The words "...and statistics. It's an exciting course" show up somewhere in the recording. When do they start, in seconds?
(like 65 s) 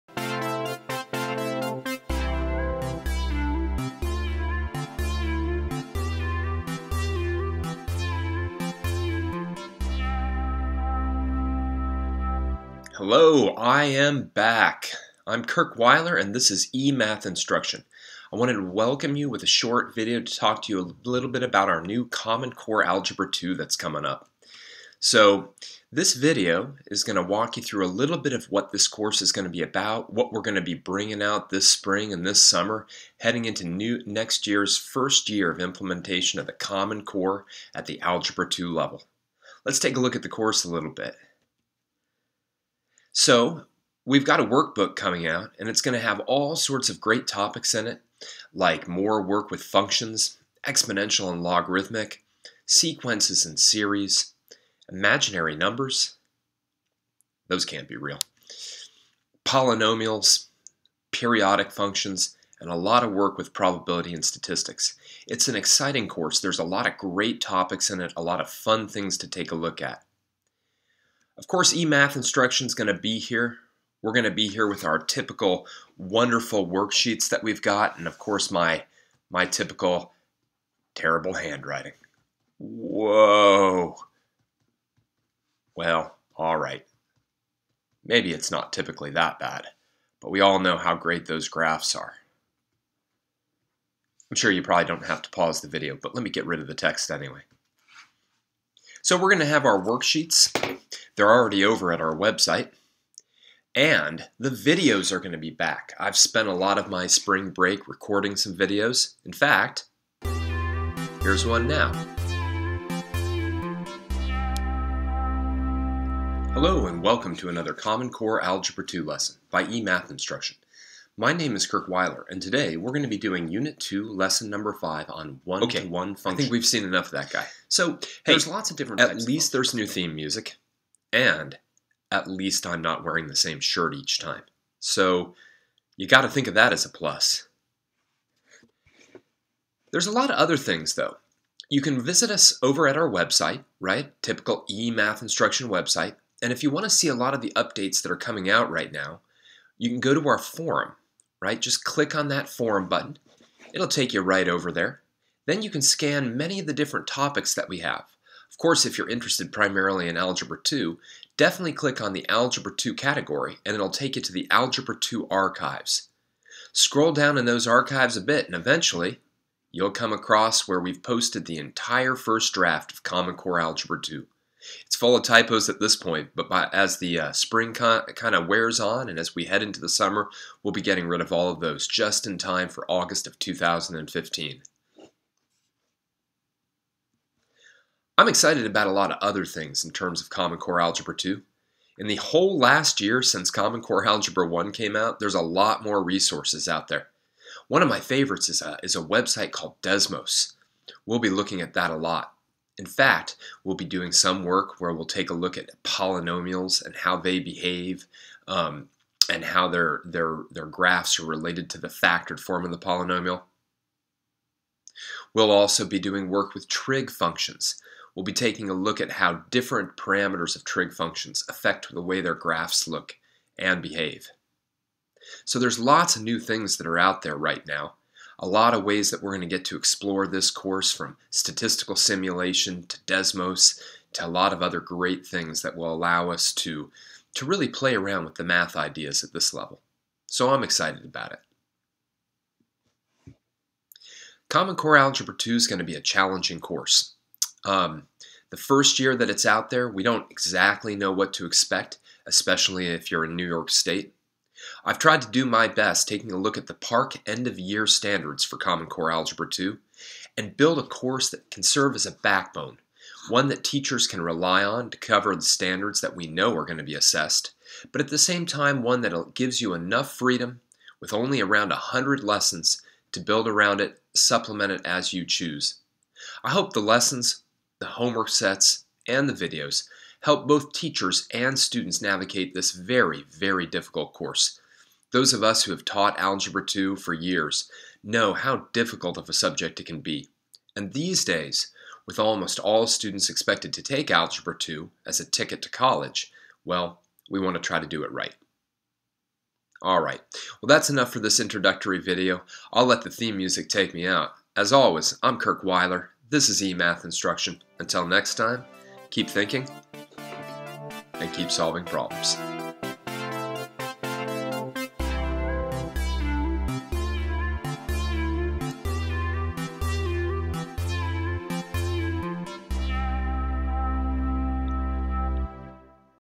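64 s.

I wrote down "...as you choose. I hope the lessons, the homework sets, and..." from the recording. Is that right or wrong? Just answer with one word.
right.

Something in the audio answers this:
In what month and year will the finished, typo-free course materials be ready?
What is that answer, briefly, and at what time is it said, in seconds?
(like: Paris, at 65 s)
August 2015, at 182 s.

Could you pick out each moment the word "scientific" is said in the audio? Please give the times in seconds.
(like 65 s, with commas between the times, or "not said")
not said.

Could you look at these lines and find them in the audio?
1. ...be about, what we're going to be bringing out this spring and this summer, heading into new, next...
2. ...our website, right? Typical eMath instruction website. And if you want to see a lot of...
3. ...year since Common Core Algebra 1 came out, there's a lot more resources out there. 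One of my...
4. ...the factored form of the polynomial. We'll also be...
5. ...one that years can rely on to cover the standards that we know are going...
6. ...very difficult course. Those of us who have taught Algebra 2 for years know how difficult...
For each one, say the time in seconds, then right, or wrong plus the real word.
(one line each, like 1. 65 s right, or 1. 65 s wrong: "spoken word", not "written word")
1. 29 s right
2. 142 s right
3. 193 s right
4. 211 s right
5. 263 s wrong: "teachers", not "years"
6. 283 s right.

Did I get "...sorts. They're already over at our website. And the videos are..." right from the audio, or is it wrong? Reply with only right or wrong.
wrong.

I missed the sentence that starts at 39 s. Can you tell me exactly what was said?
Let's take a look at the course a little bit.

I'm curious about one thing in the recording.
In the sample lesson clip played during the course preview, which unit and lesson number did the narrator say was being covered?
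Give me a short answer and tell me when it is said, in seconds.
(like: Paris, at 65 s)
Unit 2, Lesson 5, at 123 s.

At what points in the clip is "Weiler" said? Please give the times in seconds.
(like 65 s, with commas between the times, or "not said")
15 s, 121 s, 305 s.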